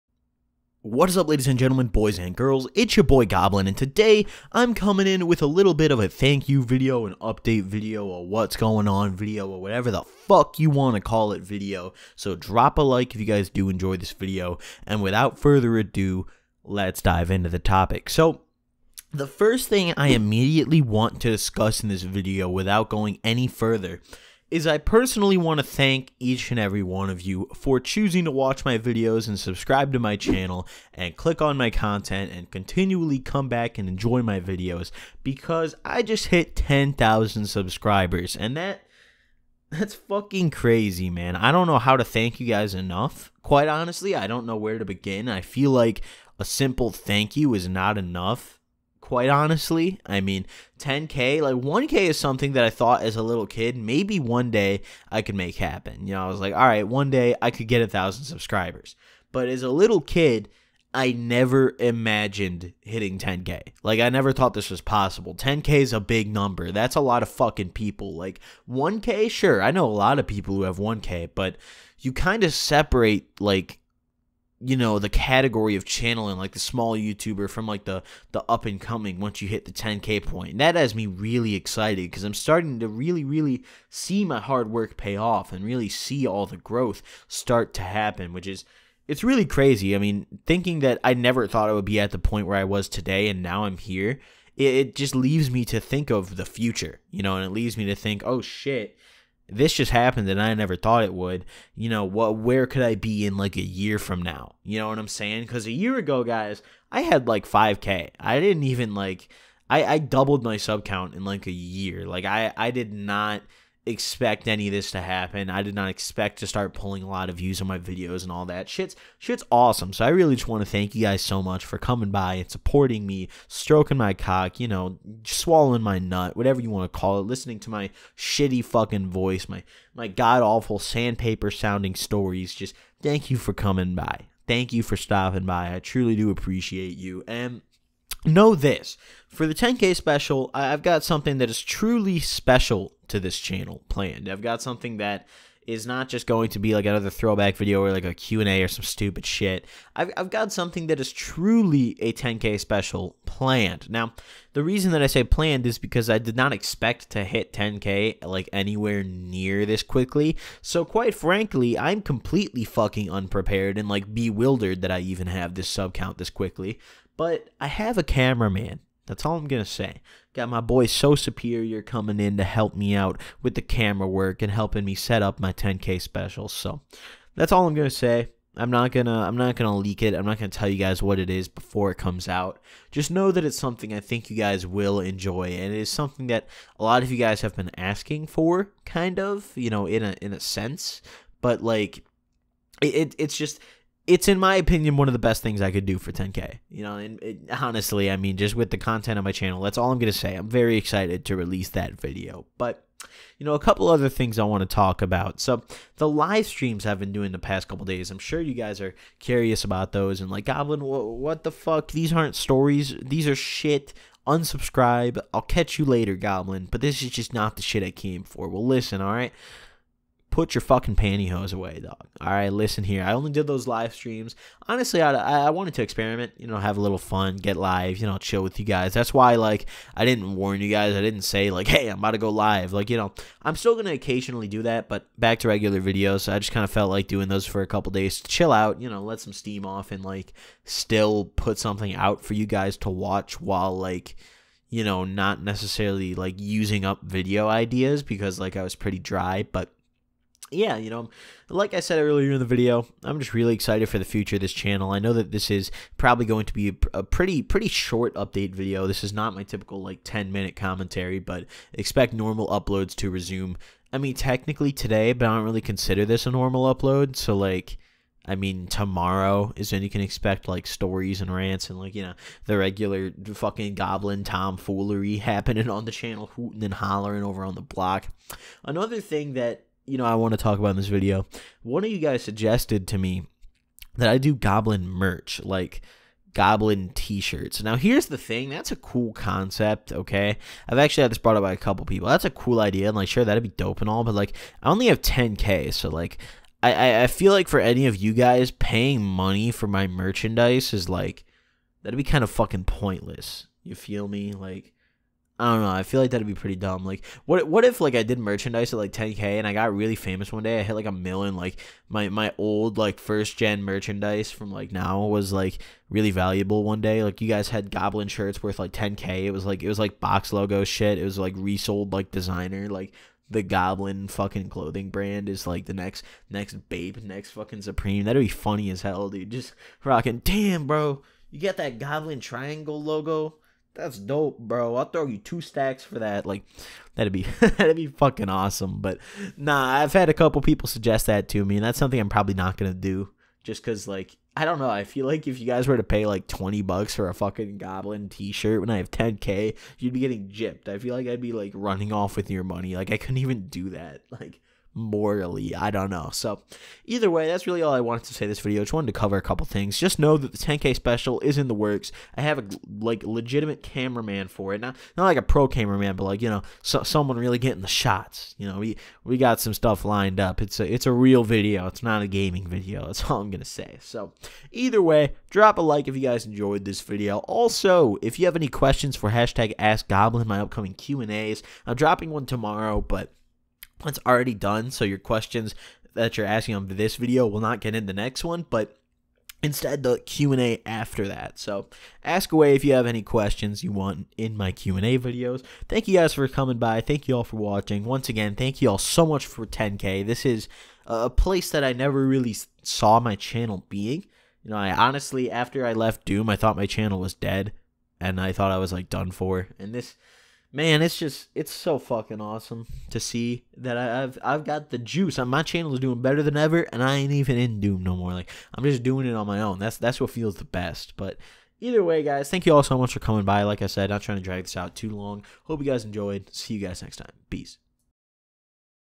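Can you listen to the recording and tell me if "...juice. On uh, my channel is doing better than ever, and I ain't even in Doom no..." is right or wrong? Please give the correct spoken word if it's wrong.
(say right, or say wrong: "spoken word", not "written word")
right.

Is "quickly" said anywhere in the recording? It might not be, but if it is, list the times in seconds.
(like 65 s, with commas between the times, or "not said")
159 s, 166 s.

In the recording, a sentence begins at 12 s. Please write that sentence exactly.
So drop a like if you guys do enjoy this video, and without further ado, let's dive into the topic.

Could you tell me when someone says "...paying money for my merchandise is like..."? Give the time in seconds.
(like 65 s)
298 s.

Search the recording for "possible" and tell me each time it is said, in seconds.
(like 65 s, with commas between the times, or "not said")
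64 s.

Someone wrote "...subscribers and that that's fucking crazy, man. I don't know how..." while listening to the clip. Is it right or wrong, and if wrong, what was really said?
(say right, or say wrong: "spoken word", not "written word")
right.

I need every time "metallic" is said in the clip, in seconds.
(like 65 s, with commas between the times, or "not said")
not said.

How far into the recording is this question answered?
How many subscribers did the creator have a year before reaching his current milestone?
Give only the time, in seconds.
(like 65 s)
107 s.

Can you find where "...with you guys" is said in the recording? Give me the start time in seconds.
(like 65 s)
228 s.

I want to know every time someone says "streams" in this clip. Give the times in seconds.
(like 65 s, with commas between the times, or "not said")
206 s, 223 s.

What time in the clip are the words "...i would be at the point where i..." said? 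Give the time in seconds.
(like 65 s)
91 s.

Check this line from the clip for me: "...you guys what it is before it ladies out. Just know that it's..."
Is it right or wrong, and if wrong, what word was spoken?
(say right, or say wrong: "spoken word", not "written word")
wrong: "comes", not "ladies".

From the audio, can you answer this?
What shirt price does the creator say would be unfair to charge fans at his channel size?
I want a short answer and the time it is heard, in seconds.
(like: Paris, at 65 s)
$20, at 346 s.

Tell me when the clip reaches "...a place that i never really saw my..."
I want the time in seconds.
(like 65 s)
400 s.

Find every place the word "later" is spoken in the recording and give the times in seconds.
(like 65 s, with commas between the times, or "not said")
215 s.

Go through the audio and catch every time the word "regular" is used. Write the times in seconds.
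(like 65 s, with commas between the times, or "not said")
235 s, 272 s.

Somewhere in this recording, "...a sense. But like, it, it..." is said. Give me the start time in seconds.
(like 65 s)
190 s.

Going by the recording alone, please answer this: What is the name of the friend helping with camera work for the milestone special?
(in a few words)
So Superior.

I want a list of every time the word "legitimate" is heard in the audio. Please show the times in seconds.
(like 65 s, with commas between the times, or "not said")
363 s.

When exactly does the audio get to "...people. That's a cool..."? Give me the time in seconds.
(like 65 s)
291 s.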